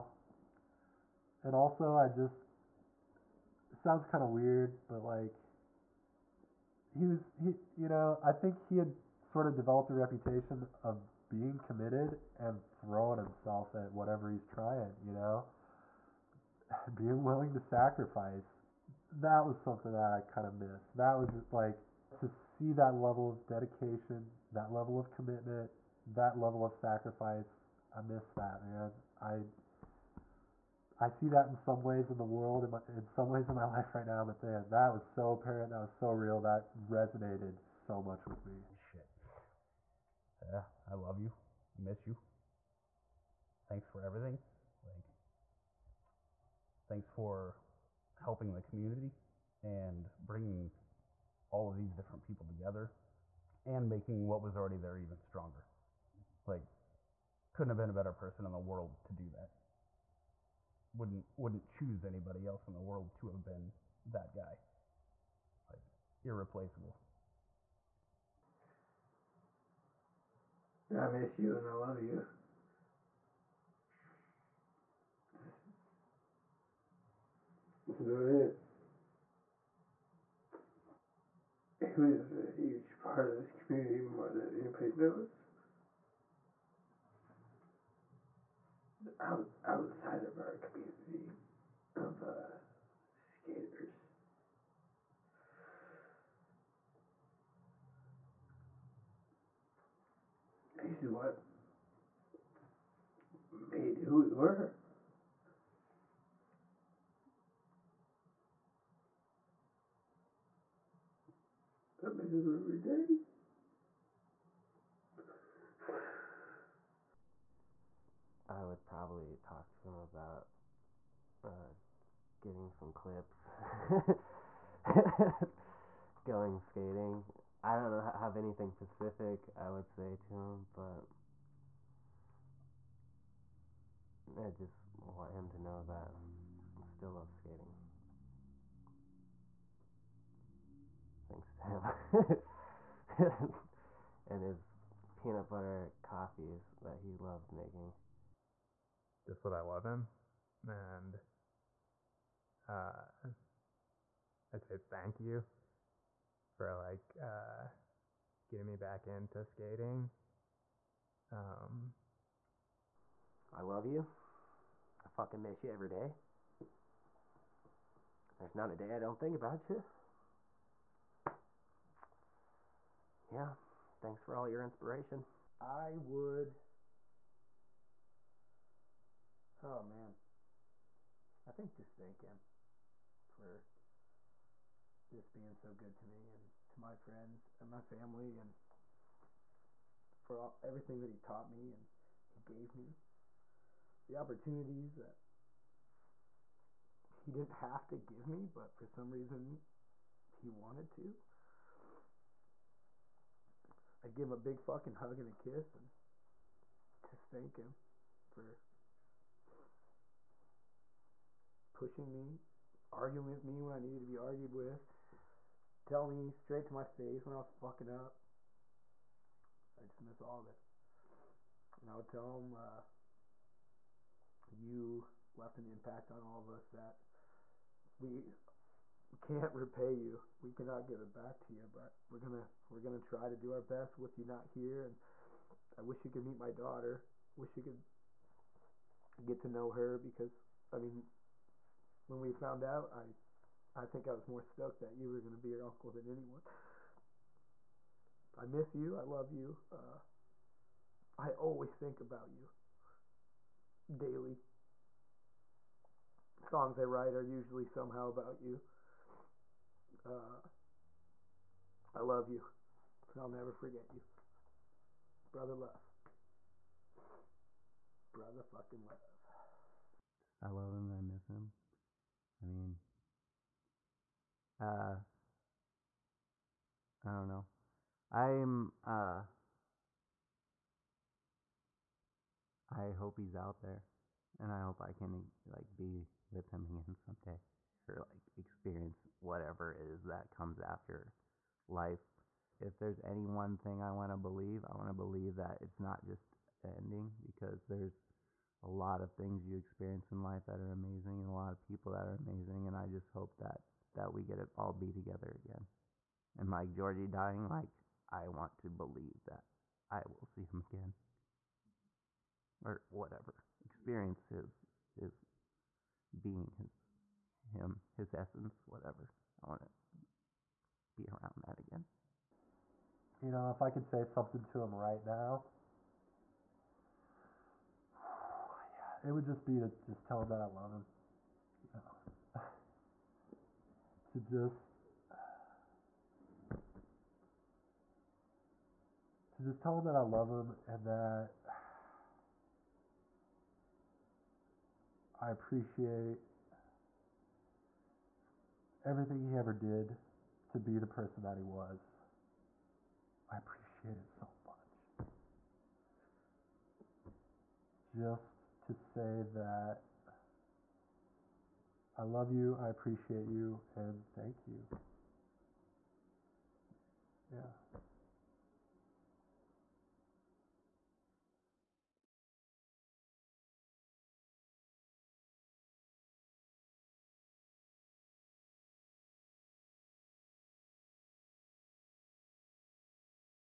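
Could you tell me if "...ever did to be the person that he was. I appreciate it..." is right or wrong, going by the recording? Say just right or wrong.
right.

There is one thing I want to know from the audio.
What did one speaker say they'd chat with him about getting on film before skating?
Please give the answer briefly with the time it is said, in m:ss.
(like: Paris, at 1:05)
clips, at 2:02.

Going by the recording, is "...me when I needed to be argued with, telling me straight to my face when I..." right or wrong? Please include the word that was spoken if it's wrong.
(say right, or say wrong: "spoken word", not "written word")
right.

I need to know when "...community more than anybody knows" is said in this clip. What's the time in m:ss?
1:23.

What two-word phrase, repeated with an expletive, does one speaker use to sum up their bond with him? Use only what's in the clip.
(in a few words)
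Brother love.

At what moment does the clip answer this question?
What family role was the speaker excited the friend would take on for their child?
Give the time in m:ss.
4:05.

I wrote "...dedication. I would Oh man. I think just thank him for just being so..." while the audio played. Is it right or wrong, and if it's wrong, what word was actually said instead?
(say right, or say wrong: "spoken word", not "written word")
wrong: "inspiration", not "dedication".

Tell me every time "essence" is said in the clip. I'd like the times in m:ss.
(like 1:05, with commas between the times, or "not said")
5:18.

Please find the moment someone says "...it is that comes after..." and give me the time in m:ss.
4:49.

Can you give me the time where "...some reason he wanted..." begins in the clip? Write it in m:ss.
3:18.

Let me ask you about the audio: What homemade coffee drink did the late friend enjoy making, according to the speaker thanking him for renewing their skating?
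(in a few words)
peanut butter coffees.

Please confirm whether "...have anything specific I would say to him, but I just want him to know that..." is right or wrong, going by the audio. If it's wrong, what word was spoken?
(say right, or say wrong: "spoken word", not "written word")
right.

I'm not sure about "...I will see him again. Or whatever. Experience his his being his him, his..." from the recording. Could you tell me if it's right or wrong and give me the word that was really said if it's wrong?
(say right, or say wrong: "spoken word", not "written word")
right.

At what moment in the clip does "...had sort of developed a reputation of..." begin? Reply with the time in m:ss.
0:08.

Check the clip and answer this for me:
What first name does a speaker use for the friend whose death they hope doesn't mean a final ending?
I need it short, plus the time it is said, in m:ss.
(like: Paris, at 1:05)
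Georgie, at 5:06.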